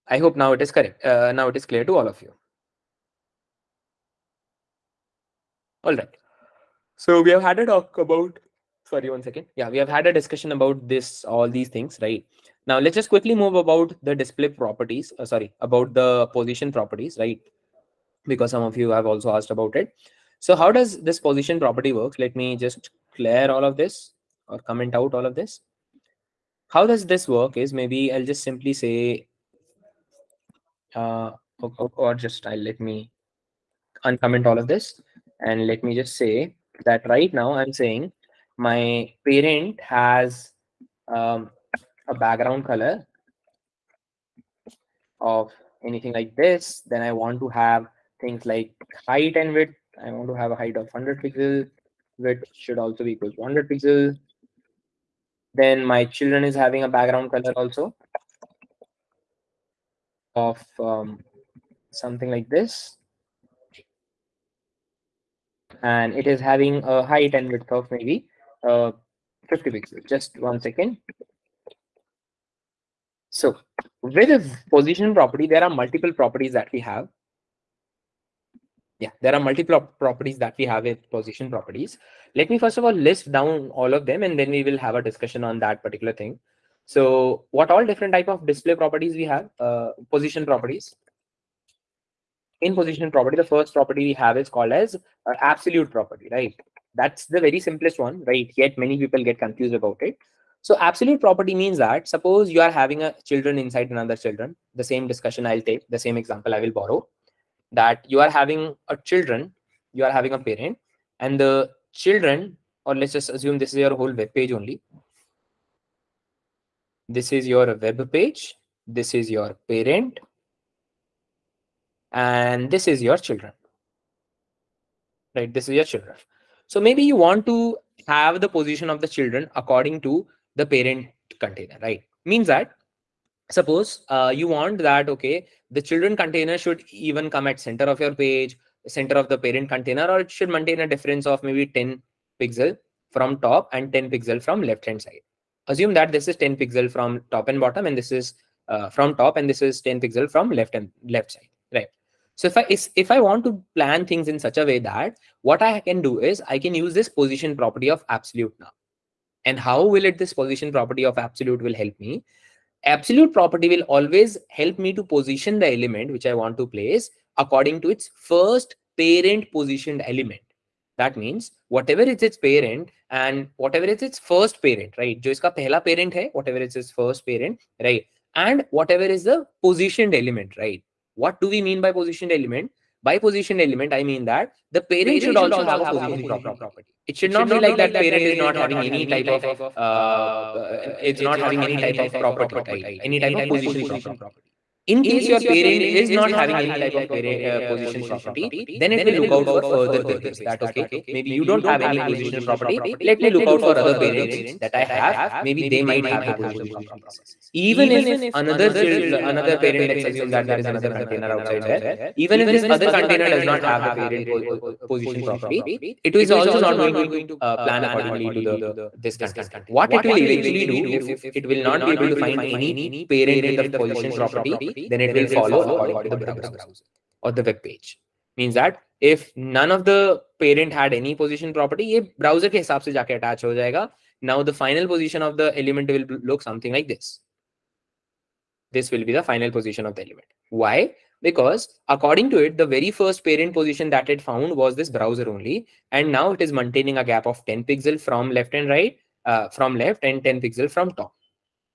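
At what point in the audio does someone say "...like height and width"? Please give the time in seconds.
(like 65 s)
48 s.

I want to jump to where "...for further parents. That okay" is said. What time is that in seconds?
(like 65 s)
199 s.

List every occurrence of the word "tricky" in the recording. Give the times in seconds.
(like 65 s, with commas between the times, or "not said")
not said.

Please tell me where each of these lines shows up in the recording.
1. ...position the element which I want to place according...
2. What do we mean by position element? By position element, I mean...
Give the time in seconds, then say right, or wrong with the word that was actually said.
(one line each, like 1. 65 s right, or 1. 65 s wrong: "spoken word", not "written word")
1. 165 s right
2. 181 s right.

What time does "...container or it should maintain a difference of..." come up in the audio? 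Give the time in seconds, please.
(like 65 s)
139 s.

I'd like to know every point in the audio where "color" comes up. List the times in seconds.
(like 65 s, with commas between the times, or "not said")
42 s, 57 s.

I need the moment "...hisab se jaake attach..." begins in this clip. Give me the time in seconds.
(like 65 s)
232 s.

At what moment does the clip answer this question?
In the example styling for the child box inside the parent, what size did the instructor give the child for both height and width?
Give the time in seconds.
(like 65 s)
69 s.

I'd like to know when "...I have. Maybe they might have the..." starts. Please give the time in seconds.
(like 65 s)
204 s.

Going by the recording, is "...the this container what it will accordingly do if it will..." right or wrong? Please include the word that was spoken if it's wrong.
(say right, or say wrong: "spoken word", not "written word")
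wrong: "eventually", not "accordingly".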